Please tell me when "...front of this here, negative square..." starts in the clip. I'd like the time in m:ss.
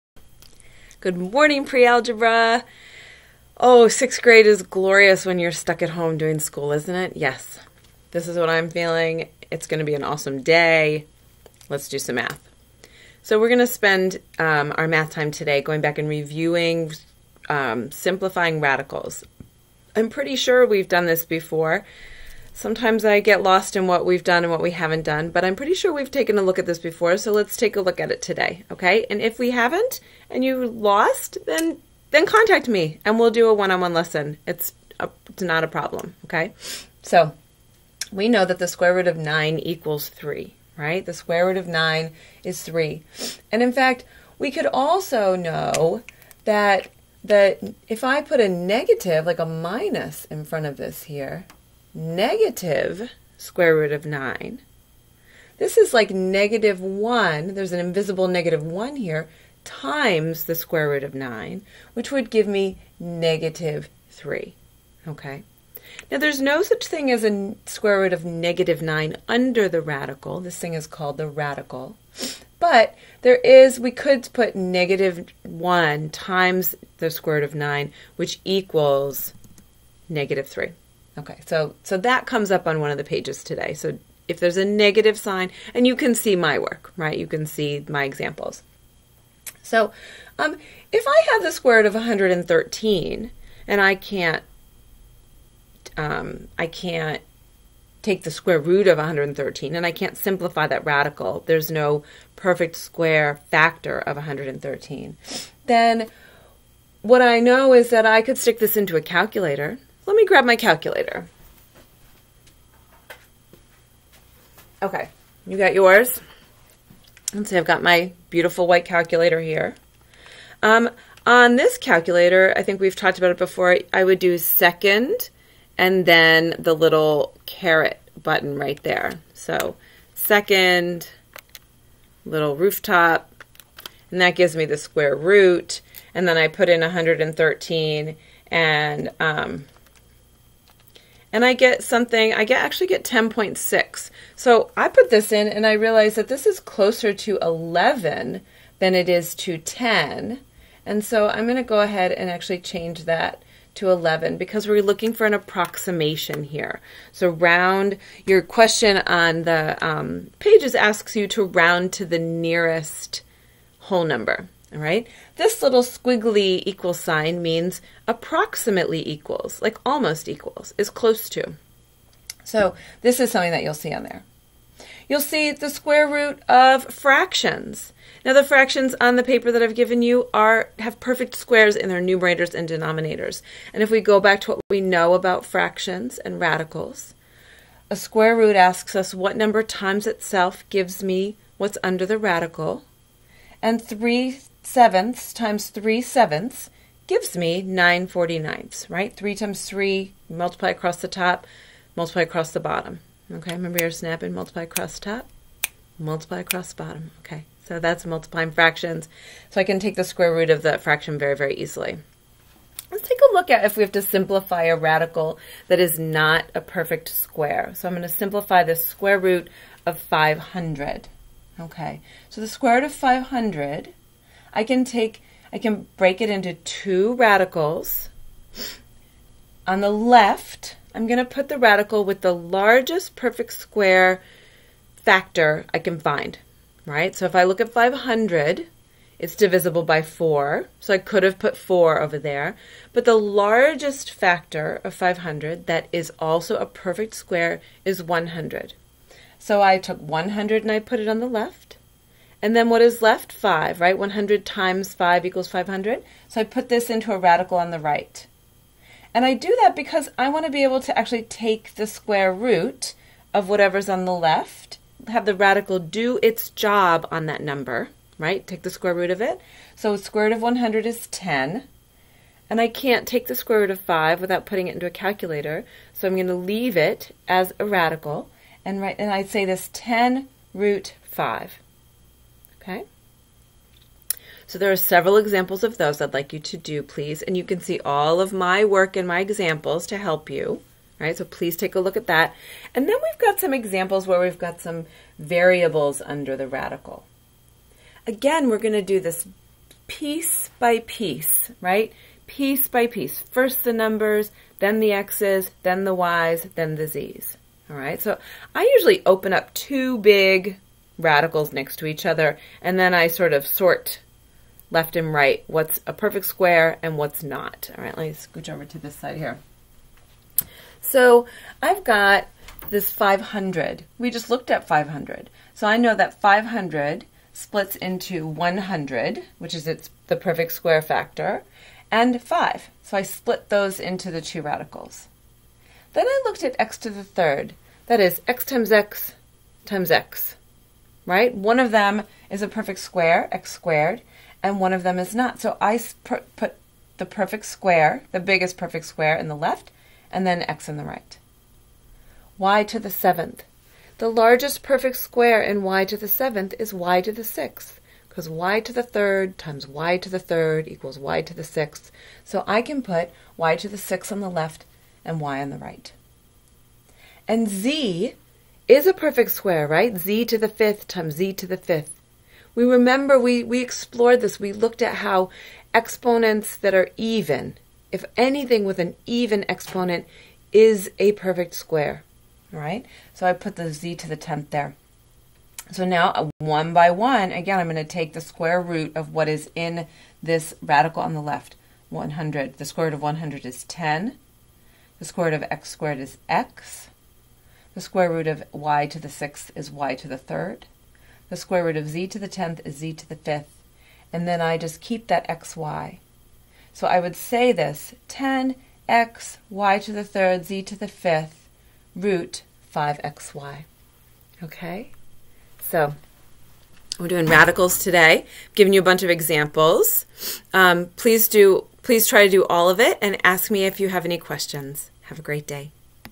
0:50.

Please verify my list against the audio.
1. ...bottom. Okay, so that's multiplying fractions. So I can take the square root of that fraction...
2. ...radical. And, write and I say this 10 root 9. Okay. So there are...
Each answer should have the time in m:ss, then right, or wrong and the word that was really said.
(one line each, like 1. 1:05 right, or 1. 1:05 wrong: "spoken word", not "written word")
1. 3:26 right
2. 4:37 wrong: "5", not "9".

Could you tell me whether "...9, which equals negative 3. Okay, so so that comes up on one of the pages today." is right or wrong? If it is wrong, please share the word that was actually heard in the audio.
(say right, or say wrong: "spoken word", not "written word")
right.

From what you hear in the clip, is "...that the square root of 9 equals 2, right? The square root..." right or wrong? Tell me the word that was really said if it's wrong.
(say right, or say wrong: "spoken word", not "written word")
wrong: "3", not "2".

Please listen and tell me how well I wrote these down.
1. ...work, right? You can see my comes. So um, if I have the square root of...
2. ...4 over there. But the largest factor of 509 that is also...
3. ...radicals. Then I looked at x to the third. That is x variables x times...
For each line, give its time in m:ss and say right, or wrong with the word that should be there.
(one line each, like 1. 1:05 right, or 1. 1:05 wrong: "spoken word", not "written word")
1. 1:26 wrong: "examples", not "comes"
2. 4:01 wrong: "500", not "509"
3. 5:34 wrong: "times", not "variables".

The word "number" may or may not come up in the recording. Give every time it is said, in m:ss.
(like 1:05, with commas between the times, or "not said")
2:44, 3:09, 4:27, 5:03.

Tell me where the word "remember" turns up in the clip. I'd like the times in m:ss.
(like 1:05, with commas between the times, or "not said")
3:23, 6:12.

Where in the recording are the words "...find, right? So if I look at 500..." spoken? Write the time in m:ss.
3:55.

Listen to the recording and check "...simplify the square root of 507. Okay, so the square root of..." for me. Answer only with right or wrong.
wrong.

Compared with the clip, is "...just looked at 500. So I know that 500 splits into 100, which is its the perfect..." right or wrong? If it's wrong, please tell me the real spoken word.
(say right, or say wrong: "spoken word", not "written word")
right.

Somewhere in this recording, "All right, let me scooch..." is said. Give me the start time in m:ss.
5:17.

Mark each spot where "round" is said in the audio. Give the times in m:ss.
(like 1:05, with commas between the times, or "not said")
2:37, 2:41.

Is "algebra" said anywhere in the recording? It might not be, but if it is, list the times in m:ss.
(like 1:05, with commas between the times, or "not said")
0:01.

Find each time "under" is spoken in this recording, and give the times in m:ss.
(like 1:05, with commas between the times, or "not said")
1:09, 3:11, 4:56.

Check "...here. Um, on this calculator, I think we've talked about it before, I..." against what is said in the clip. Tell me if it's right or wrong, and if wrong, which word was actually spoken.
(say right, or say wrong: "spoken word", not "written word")
right.